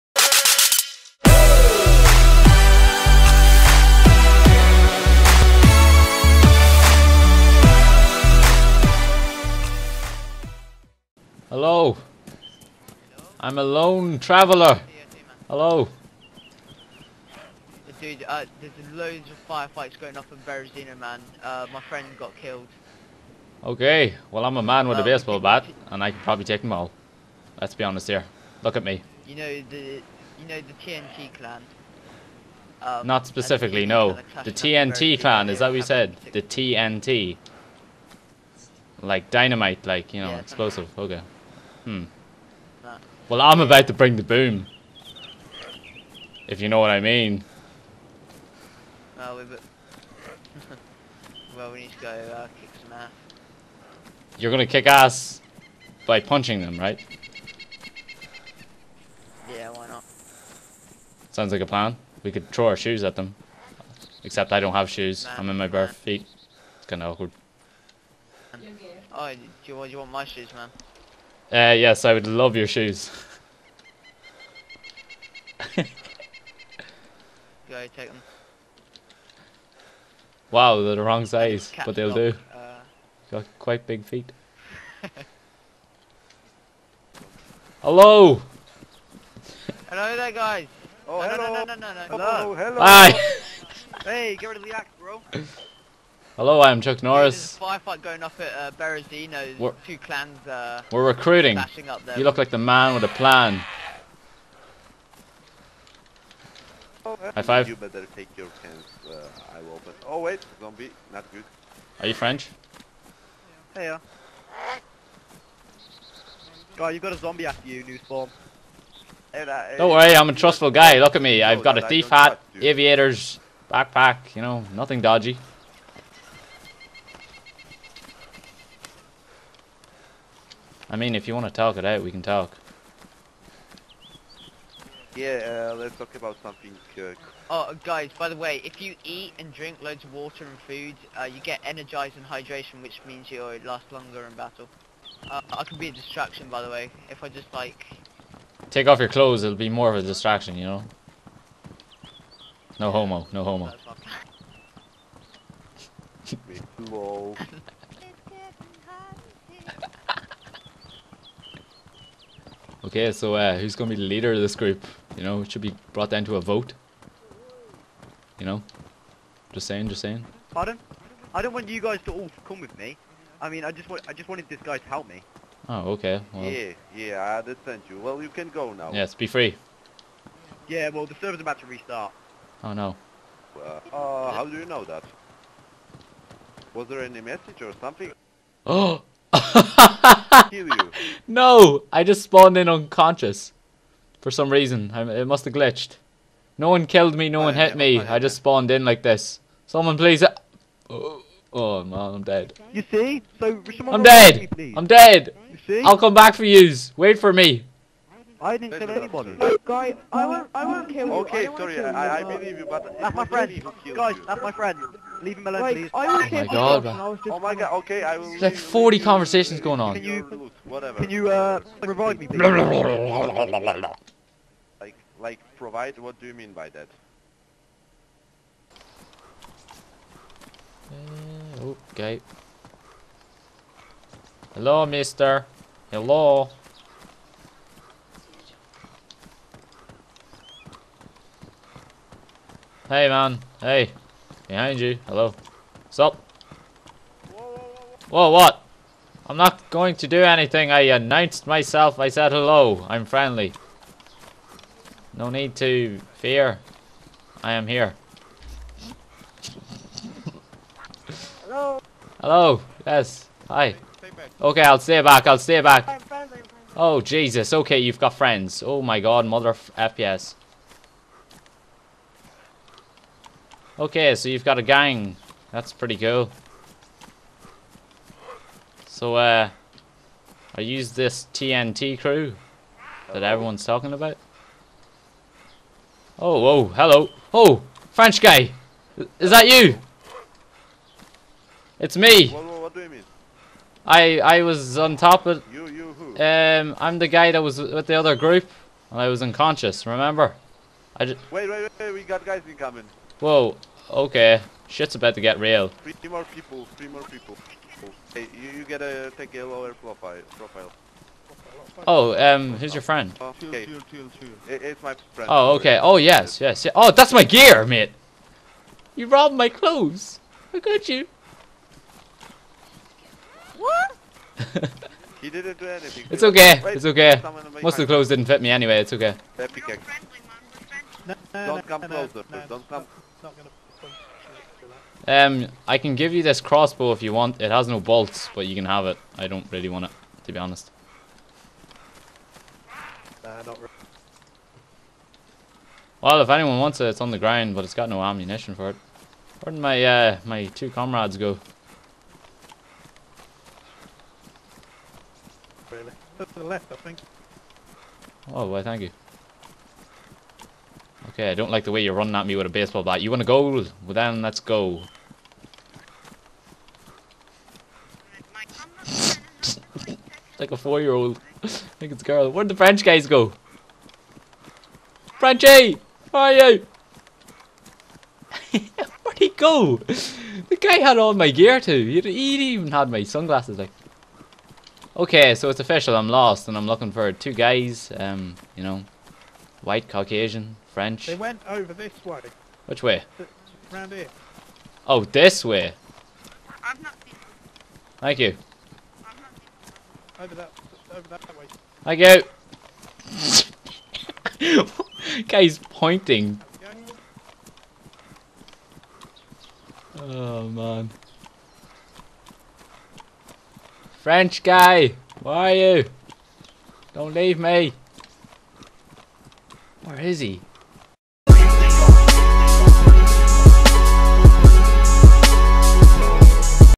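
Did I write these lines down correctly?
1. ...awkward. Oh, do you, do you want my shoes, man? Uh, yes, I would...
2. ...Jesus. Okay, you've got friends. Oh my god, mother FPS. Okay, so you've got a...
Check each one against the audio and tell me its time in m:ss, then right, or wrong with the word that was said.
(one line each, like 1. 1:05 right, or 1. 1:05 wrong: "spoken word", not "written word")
1. 1:07 right
2. 4:26 right.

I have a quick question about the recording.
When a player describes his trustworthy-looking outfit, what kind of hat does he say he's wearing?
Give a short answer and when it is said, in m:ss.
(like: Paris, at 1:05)
thief hat, at 2:01.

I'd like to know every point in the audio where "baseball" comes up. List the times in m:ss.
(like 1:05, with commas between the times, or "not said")
0:25, 6:02.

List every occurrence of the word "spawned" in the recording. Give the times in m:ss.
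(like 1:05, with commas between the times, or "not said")
3:12, 3:18.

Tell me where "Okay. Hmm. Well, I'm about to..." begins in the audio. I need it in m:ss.
0:40.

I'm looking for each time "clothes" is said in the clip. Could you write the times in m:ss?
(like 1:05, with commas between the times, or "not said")
2:29, 5:19, 5:27.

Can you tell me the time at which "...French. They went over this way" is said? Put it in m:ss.
6:30.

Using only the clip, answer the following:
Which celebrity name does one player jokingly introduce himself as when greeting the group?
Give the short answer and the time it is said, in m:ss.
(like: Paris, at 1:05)
Chuck Norris, at 1:36.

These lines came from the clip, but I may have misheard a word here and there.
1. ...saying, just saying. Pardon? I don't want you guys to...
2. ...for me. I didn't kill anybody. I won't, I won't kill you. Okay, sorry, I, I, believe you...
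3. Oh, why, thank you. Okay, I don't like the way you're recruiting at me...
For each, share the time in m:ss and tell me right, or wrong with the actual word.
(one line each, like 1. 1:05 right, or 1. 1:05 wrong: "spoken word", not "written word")
1. 2:49 right
2. 3:27 right
3. 5:58 wrong: "running", not "recruiting".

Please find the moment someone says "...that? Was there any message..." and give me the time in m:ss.
3:04.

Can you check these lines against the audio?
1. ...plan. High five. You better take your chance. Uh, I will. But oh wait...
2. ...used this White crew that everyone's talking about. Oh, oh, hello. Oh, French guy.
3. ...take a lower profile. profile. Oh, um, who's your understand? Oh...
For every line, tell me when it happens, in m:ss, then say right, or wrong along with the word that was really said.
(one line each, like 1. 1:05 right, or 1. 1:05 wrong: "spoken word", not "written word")
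1. 1:43 right
2. 4:40 wrong: "TNT", not "White"
3. 5:09 wrong: "friend", not "understand".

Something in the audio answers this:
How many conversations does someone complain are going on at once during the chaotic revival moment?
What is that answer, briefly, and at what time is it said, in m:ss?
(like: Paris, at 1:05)
40, at 3:38.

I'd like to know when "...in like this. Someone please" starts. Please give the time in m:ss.
3:18.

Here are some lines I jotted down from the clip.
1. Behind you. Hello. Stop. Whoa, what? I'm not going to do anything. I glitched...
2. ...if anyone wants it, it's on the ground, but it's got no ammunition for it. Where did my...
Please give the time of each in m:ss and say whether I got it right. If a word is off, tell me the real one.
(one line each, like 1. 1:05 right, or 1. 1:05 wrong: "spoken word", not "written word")
1. 4:04 wrong: "announced", not "glitched"
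2. 5:46 right.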